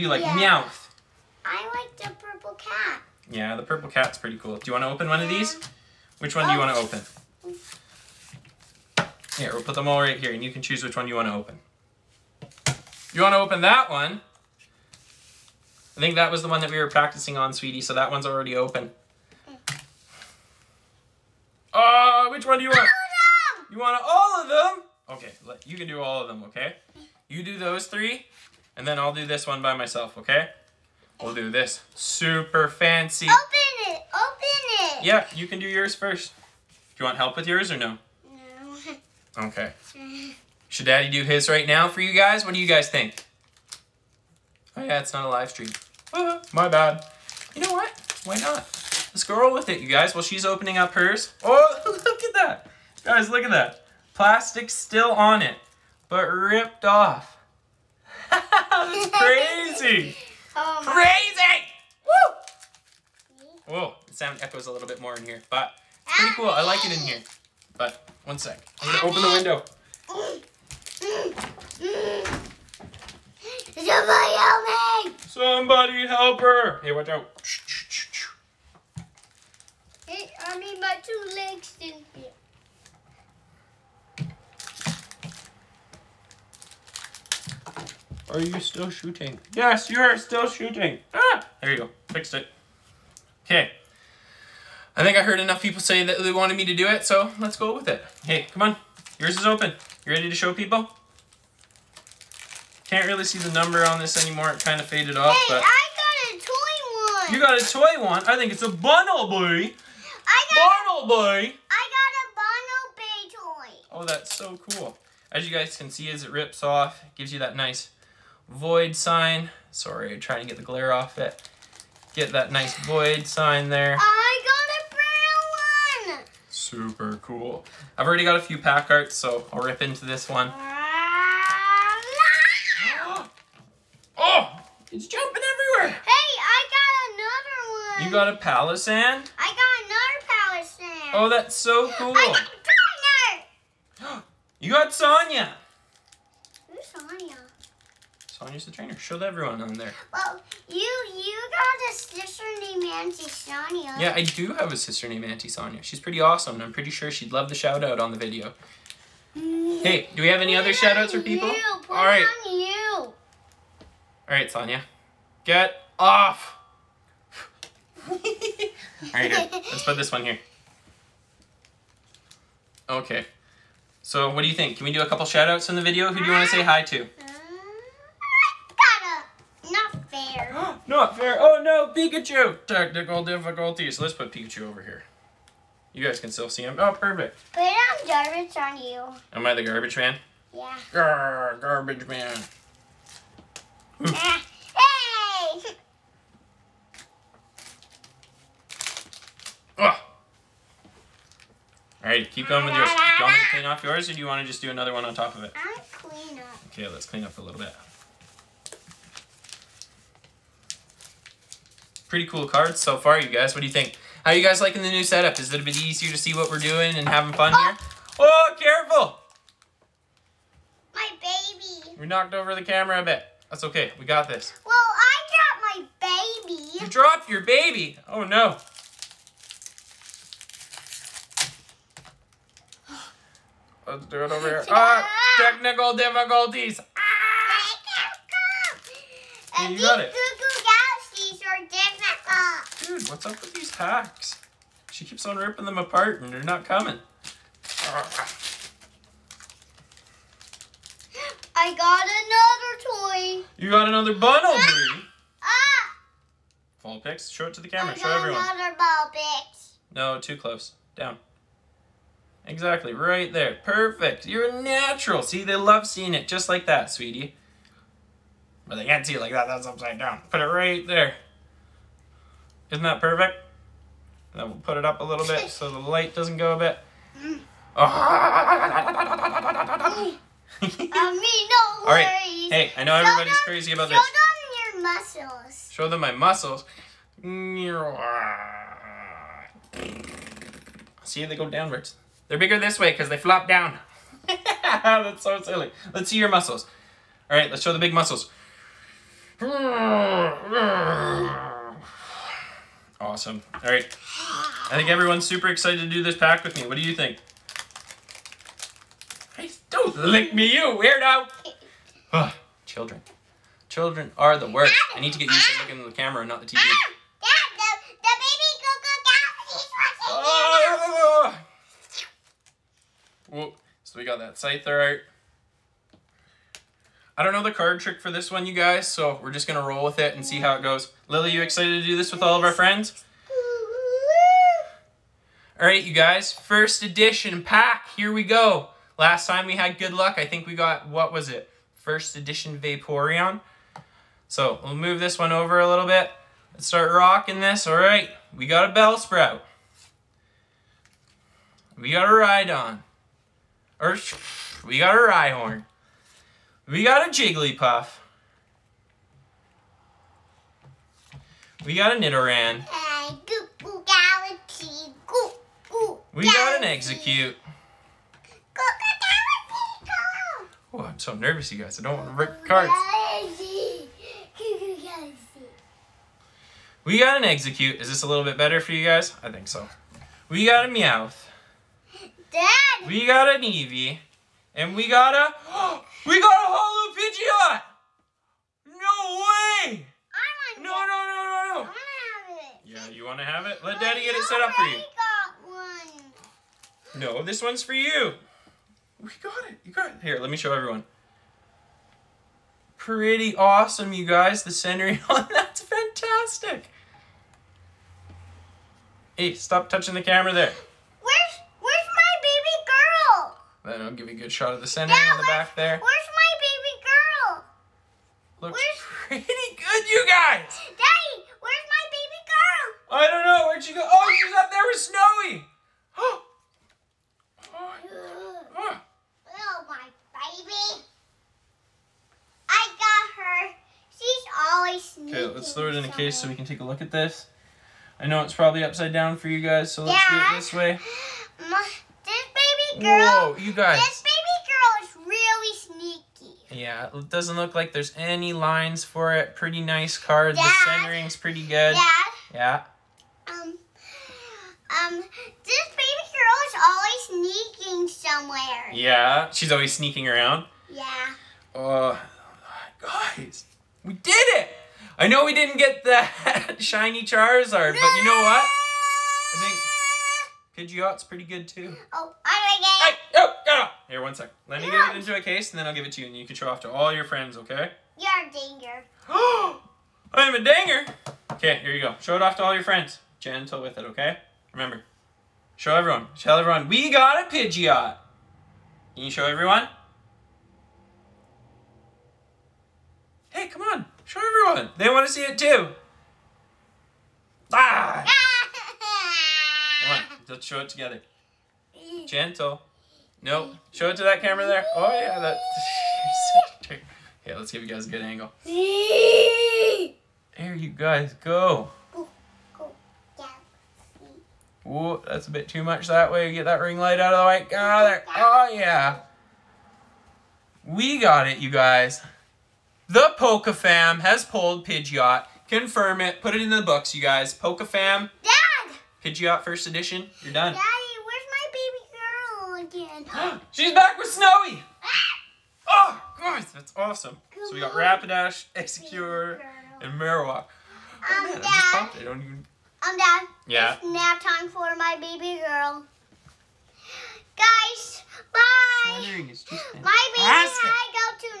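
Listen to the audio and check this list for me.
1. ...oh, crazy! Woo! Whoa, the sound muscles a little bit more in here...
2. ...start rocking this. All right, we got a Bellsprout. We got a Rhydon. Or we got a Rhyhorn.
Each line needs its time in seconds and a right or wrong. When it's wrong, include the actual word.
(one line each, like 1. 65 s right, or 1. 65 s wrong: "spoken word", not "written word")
1. 60 s wrong: "echoes", not "muscles"
2. 346 s right.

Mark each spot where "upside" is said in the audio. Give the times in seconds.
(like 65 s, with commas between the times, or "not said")
269 s, 438 s.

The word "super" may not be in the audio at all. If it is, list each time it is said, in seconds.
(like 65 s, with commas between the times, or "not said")
31 s, 126 s, 305 s.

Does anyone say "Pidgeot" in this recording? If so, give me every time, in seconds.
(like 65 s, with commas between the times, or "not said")
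386 s, 470 s, 487 s, 524 s.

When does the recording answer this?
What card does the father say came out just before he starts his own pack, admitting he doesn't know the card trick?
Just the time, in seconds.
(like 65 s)
324 s.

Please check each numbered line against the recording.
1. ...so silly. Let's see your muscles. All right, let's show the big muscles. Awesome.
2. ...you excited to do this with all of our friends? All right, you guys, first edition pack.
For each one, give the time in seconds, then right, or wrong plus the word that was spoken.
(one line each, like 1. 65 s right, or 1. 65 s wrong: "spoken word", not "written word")
1. 295 s right
2. 331 s right.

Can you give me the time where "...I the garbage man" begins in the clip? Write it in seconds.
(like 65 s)
189 s.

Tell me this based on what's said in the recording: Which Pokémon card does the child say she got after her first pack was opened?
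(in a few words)
Bunnelby.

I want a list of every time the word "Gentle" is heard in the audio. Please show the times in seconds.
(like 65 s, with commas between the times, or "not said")
483 s, 502 s.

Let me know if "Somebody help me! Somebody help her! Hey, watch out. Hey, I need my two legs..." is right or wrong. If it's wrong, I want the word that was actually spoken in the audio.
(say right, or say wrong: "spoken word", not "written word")
right.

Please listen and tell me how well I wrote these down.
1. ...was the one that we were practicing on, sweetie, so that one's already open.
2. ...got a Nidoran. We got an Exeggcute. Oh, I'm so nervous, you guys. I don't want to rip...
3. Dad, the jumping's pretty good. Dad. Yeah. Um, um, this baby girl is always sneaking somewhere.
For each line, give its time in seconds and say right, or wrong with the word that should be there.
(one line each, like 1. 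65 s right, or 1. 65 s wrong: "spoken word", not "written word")
1. 16 s right
2. 361 s right
3. 450 s wrong: "centering", not "jumping".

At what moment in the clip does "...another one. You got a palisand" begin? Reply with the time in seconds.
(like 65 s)
137 s.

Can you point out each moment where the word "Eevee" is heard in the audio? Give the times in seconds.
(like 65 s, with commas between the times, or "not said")
383 s.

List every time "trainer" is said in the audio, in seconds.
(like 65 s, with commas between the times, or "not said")
148 s.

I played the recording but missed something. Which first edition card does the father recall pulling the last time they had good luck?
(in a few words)
Vaporeon.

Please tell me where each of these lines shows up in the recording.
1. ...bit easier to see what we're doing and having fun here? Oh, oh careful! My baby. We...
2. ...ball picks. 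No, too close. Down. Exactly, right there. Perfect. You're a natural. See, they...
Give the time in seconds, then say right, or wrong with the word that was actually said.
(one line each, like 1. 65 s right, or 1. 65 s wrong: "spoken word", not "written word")
1. 215 s right
2. 258 s right.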